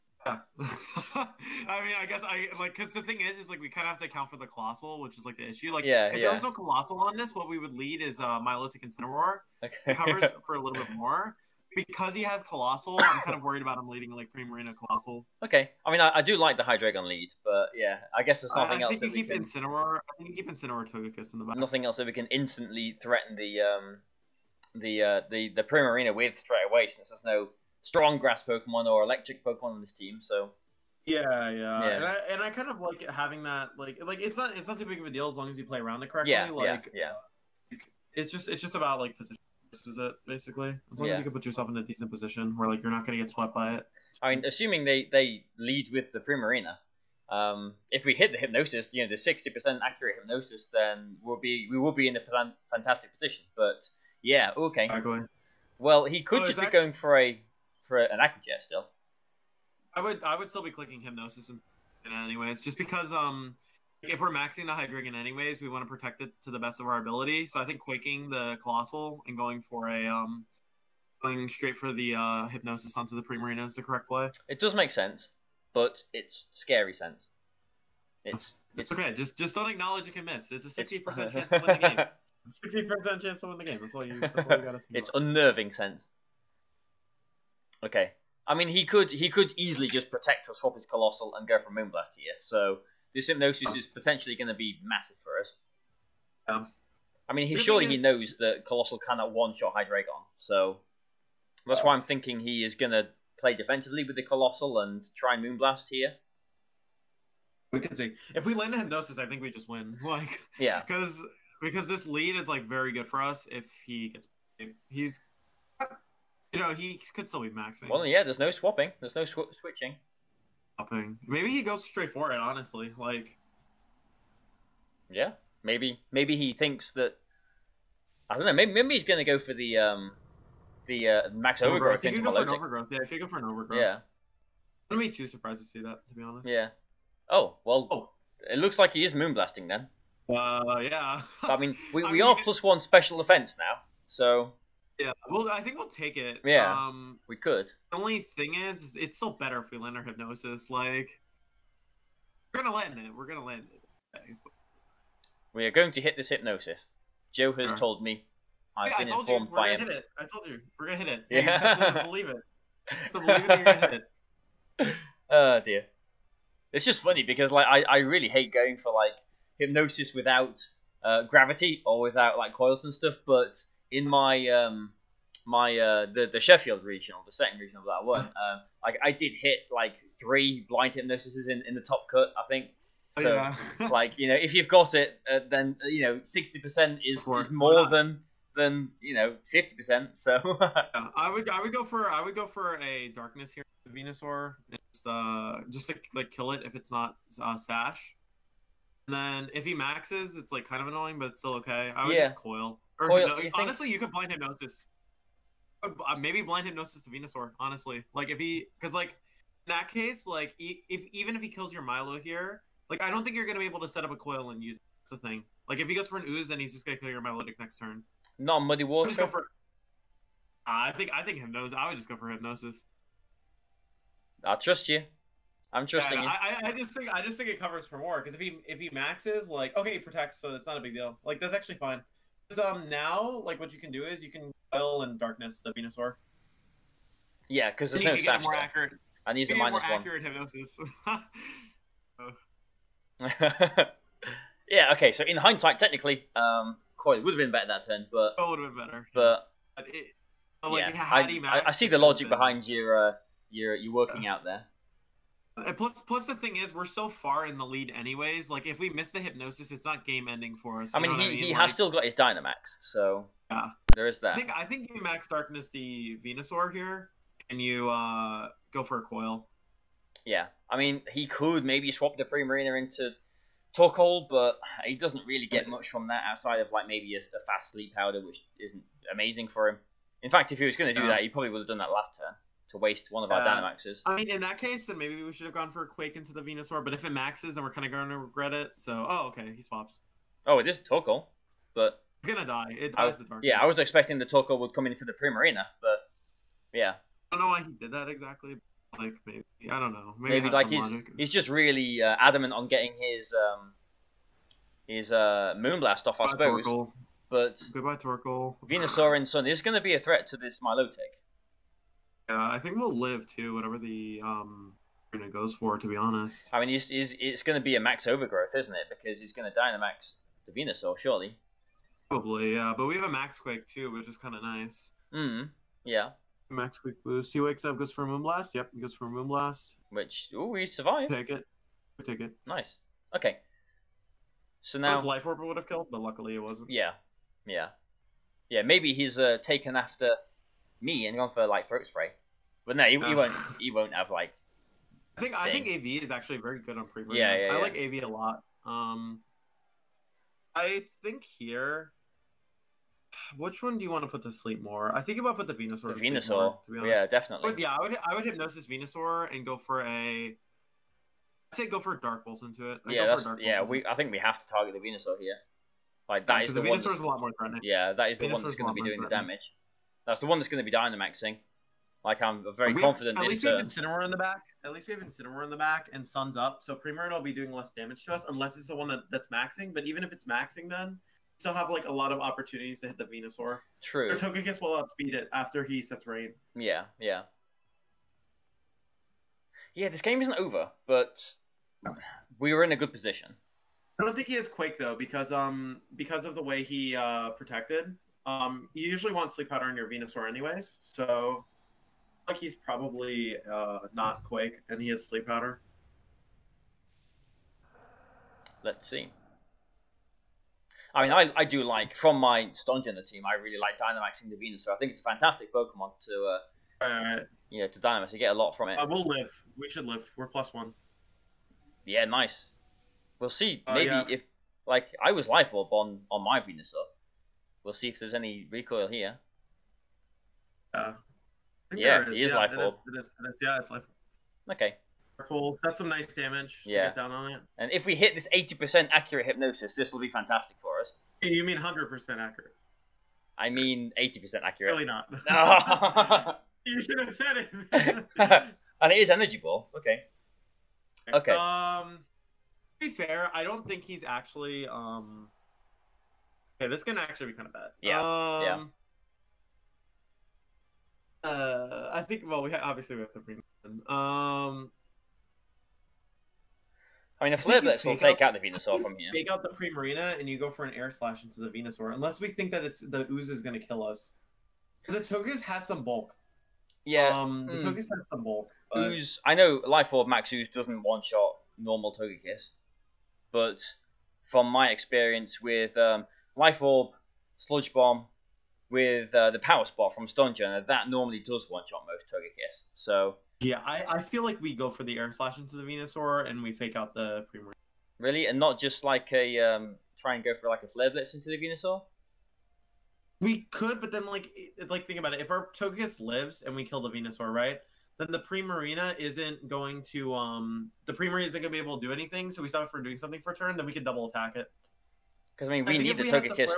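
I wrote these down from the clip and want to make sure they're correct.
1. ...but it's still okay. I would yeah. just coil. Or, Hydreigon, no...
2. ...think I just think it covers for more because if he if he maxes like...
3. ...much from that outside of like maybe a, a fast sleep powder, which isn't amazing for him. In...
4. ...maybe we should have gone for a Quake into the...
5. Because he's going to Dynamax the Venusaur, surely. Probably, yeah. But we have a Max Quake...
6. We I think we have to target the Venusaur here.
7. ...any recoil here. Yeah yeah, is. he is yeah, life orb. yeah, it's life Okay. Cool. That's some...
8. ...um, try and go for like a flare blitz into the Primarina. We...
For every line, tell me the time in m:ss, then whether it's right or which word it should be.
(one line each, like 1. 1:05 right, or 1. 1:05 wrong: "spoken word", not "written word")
1. 3:21 wrong: "Coil", not "Hydreigon"
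2. 3:46 right
3. 4:35 right
4. 4:44 right
5. 5:18 right
6. 6:03 right
7. 7:08 right
8. 8:19 wrong: "Venusaur", not "Primarina".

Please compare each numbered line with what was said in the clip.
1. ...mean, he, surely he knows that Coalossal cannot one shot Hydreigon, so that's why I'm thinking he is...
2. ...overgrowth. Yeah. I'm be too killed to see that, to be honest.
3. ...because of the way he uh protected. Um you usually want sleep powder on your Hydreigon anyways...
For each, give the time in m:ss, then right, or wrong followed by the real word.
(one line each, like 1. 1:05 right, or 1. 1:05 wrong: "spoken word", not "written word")
1. 1:37 right
2. 2:13 wrong: "surprised", not "killed"
3. 6:35 wrong: "Venusaur", not "Hydreigon".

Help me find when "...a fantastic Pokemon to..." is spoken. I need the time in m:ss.
6:54.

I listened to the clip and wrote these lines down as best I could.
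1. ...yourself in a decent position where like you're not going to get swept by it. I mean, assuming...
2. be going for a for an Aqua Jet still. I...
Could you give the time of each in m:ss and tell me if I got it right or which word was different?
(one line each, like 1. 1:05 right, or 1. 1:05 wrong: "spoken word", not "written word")
1. 0:41 right
2. 0:56 right.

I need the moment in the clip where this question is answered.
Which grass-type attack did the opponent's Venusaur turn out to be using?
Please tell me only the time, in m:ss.
7:29.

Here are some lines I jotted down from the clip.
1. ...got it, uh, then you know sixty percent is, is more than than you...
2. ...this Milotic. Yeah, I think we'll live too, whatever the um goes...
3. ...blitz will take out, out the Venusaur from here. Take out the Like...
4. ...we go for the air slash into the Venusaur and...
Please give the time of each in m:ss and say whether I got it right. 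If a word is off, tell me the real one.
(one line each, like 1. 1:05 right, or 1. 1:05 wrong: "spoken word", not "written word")
1. 3:04 right
2. 5:10 right
3. 7:47 wrong: "Primarina", not "Like"
4. 8:14 right.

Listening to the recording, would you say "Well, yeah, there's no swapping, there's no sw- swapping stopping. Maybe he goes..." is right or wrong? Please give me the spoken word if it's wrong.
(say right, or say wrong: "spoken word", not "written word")
wrong: "switching", not "swapping".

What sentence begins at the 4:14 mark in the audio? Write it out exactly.
out there, uh, plus, plus the thing is, we're so far in the lead, anyways.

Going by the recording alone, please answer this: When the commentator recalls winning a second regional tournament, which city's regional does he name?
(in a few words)
Sheffield.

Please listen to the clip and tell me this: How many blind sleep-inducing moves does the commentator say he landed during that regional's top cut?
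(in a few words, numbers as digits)
3.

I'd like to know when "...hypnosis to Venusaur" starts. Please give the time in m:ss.
3:26.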